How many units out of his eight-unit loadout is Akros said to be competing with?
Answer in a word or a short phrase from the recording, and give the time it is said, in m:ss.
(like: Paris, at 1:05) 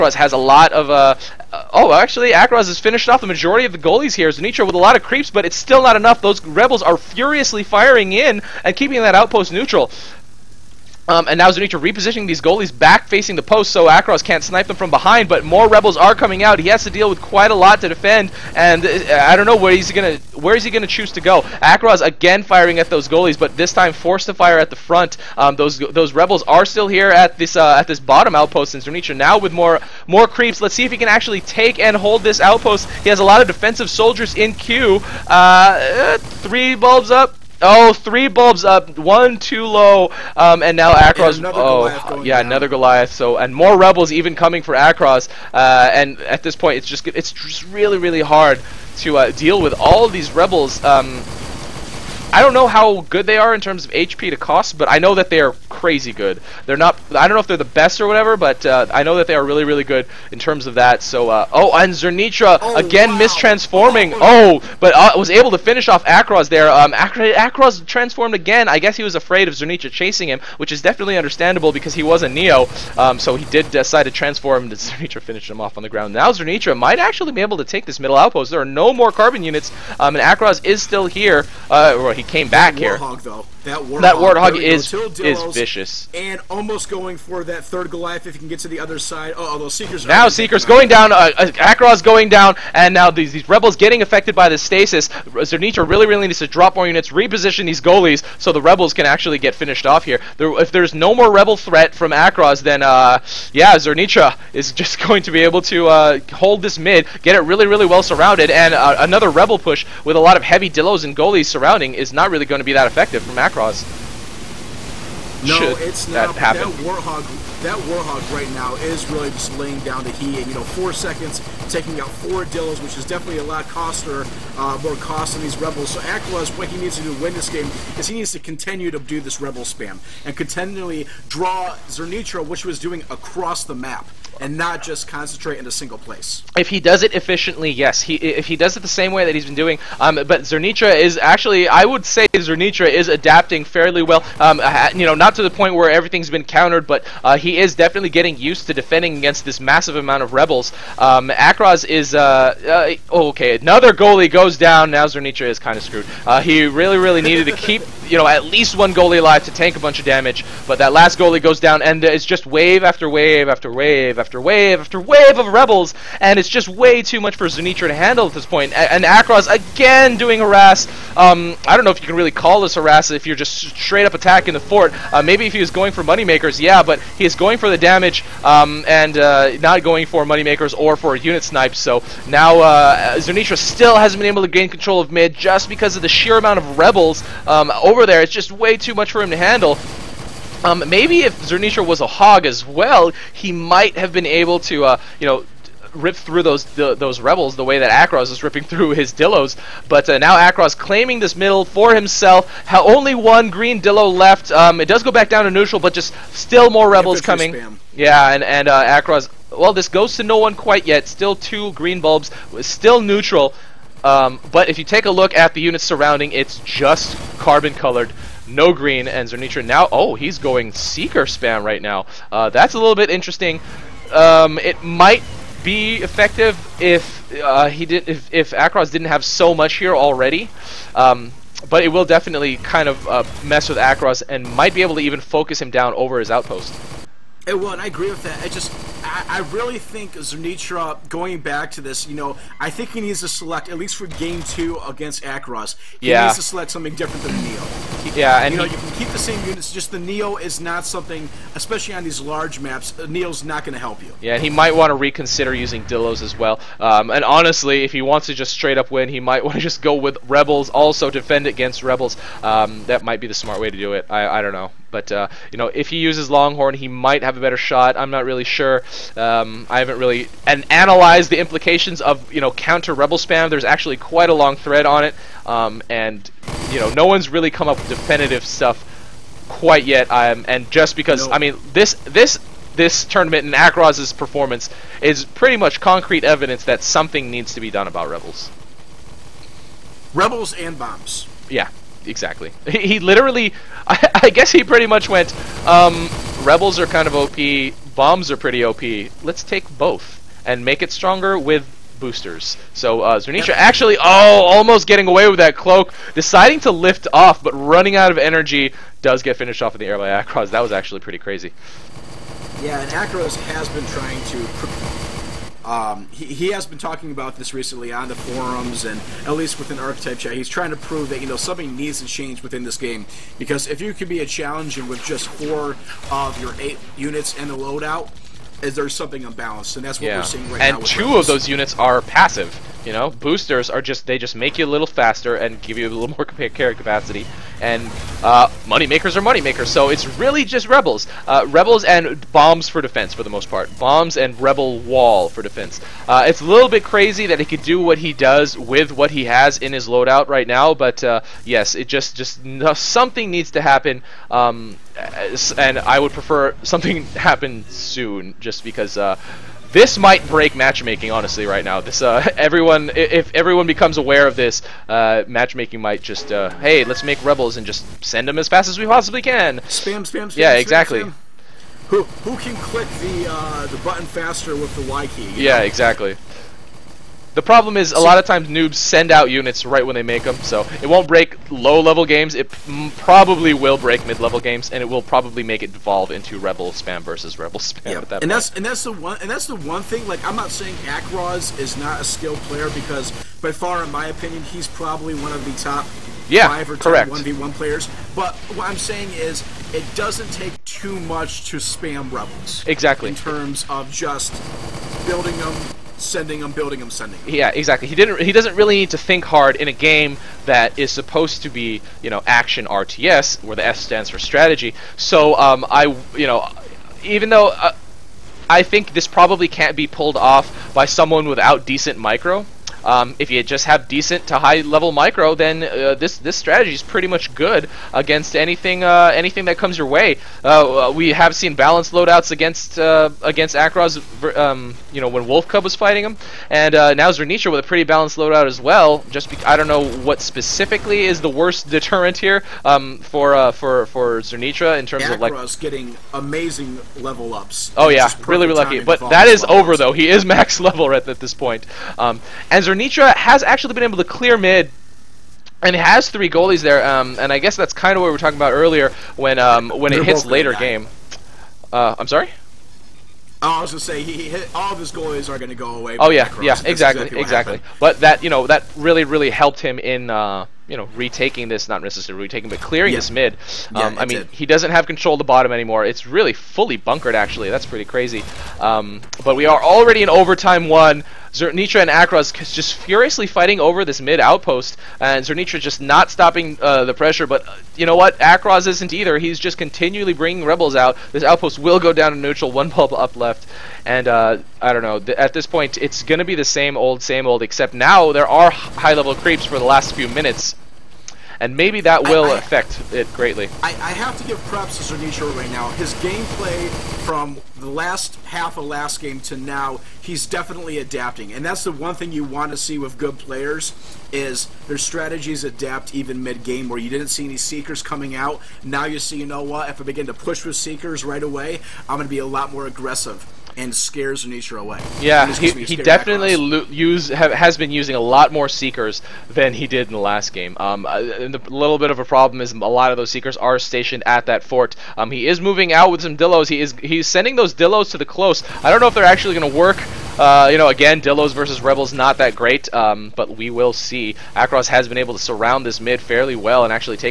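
4, at 5:25.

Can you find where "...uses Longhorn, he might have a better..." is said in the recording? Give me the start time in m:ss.
4:25.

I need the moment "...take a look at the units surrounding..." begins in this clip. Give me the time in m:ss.
3:34.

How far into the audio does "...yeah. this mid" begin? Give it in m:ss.
7:52.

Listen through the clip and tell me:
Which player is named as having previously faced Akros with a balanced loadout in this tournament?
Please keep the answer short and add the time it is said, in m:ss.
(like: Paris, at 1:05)
Wolf Cub, at 7:15.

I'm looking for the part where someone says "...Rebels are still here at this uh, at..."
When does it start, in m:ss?
0:26.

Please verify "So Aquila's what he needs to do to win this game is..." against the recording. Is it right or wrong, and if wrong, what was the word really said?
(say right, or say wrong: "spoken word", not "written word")
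right.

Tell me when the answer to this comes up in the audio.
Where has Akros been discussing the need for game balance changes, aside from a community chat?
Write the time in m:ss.
5:17.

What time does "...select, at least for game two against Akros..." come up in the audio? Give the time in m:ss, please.
4:03.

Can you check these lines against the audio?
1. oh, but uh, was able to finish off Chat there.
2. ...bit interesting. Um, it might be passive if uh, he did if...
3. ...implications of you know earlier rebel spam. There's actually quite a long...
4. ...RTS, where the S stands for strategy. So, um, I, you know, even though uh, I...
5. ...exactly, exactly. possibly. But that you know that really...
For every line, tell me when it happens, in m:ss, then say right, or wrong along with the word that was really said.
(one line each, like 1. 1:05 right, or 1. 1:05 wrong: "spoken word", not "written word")
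1. 1:04 wrong: "Akros", not "Chat"
2. 3:42 wrong: "effective", not "passive"
3. 4:31 wrong: "counter", not "earlier"
4. 6:52 right
5. 7:46 wrong: "exactly", not "possibly".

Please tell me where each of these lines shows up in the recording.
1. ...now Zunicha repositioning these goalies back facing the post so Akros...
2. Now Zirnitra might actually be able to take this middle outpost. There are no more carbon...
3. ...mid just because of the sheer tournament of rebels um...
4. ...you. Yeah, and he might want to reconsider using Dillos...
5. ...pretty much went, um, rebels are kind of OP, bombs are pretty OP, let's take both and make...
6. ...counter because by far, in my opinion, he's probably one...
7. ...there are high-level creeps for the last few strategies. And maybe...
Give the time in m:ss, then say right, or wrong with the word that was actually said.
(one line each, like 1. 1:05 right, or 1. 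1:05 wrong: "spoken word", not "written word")
1. 0:11 right
2. 1:16 right
3. 3:05 wrong: "amount", not "tournament"
4. 4:14 right
5. 4:54 right
6. 6:32 wrong: "player", not "counter"
7. 8:18 wrong: "minutes", not "strategies".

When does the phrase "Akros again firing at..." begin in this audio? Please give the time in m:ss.
0:21.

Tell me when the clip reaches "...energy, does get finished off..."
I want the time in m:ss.
5:08.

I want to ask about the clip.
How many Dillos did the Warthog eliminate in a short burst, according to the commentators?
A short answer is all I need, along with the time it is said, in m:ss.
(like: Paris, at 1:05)
4, at 2:02.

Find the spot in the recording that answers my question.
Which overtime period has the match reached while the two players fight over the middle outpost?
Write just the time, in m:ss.
8:00.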